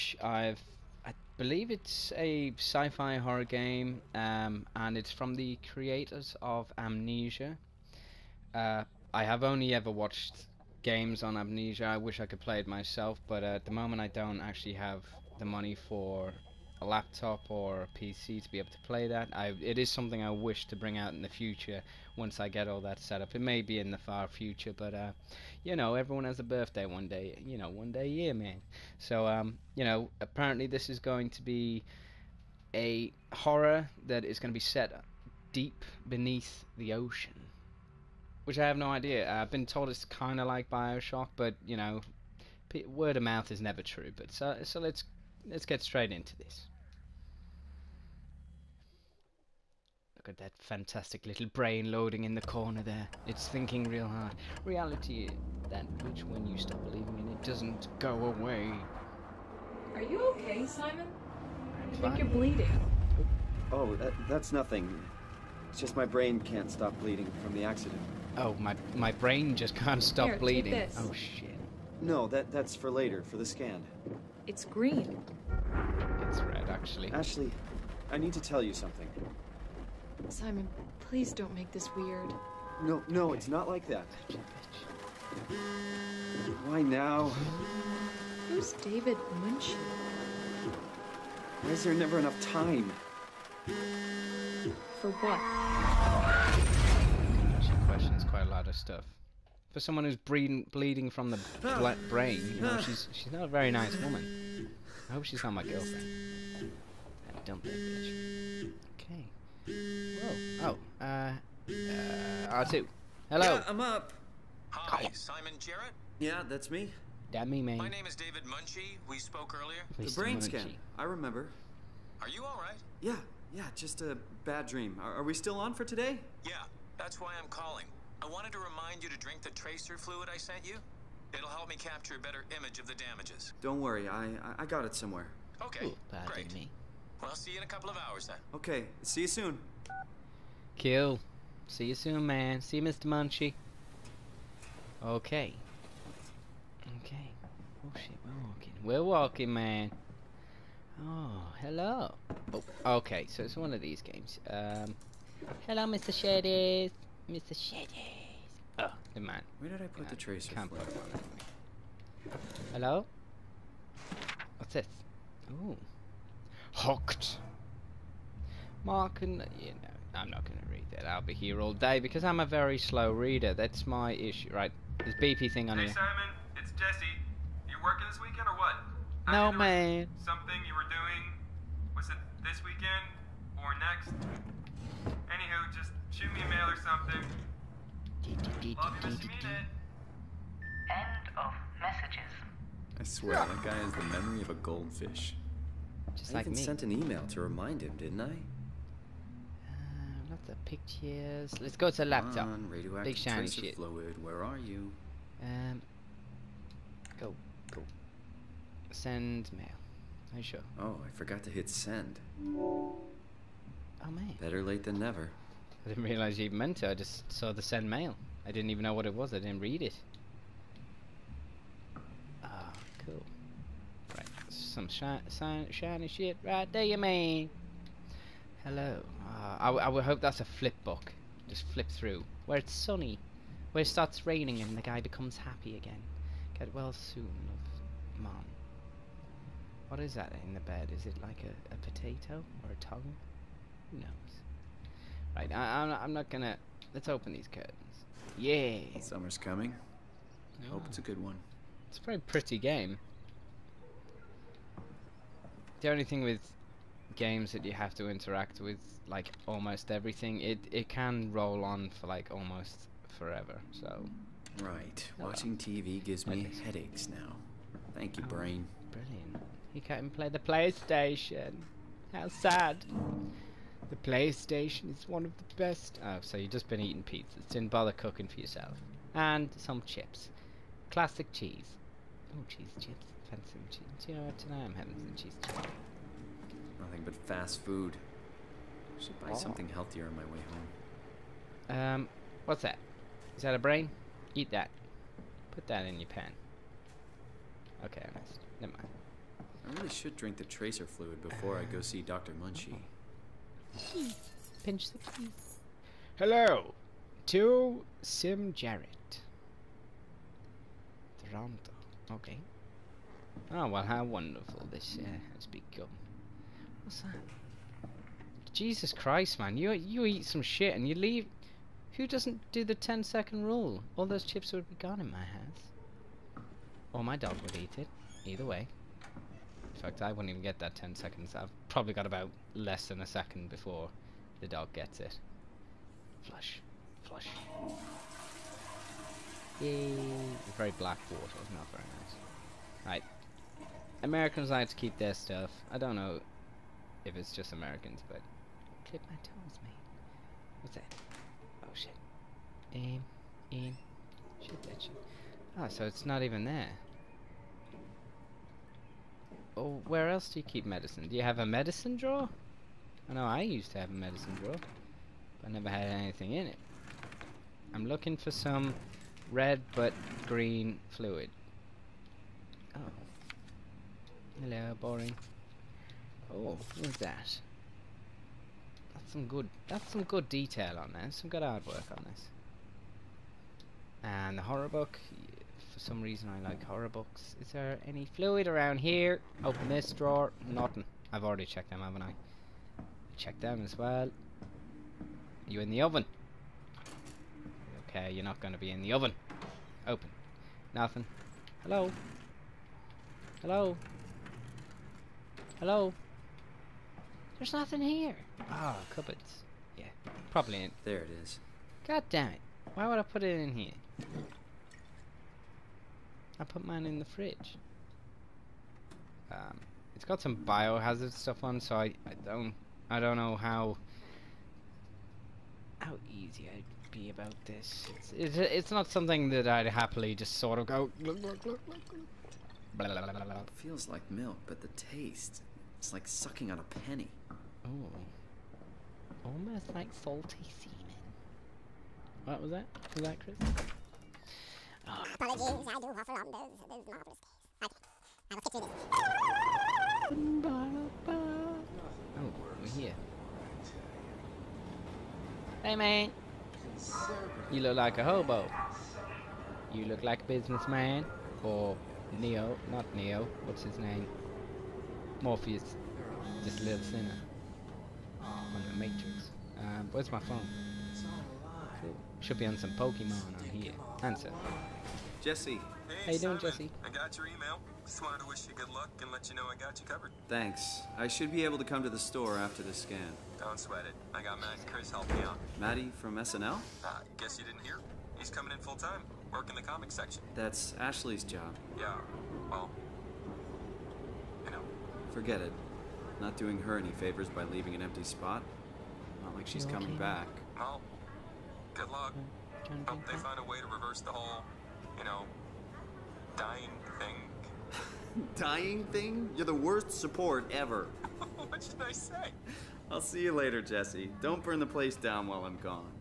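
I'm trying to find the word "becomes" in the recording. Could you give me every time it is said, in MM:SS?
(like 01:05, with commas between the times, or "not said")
03:55, 05:15.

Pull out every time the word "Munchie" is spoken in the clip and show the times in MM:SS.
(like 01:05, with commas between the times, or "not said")
02:00, 02:23.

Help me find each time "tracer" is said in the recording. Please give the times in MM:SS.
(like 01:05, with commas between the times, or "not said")
02:09, 02:40, 05:00.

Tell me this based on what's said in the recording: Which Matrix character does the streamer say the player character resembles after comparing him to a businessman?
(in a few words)
Morpheus.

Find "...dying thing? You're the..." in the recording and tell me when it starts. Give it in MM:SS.
08:28.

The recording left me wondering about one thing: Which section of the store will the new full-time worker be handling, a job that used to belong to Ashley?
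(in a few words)
Comic section.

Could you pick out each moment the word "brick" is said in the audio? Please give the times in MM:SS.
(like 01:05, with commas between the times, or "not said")
not said.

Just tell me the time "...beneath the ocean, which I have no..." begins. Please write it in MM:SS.
00:36.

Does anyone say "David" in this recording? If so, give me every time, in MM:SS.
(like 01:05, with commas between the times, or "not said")
01:28, 01:58.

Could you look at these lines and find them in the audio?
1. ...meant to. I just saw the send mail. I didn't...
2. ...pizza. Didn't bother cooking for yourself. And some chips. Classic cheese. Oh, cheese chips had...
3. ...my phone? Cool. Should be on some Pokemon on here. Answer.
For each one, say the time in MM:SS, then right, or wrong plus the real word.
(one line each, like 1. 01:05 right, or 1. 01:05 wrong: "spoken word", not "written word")
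1. 03:36 right
2. 04:37 right
3. 07:50 right.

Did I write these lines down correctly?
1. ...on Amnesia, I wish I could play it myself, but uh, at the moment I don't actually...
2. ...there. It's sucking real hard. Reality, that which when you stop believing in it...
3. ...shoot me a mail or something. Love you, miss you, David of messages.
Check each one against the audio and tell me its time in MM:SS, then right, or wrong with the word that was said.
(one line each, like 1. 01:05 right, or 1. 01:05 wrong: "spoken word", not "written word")
1. 00:11 right
2. 00:52 wrong: "thinking", not "sucking"
3. 03:06 wrong: "End", not "David".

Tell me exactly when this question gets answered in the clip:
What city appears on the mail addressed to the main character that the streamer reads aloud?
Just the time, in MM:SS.
05:11.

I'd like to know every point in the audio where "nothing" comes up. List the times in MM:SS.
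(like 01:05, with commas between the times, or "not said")
01:04, 04:46, 06:30, 06:40, 06:47.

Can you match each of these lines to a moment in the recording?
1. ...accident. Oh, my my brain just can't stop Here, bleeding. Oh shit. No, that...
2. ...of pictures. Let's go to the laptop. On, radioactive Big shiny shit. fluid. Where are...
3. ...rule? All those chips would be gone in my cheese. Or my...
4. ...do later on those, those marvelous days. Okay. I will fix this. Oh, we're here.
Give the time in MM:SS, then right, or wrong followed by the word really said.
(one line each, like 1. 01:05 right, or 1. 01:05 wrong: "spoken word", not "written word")
1. 01:07 right
2. 03:20 right
3. 05:23 wrong: "house", not "cheese"
4. 07:25 wrong: "offer", not "later".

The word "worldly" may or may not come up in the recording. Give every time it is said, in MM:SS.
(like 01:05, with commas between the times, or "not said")
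not said.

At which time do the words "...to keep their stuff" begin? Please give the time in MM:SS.
05:44.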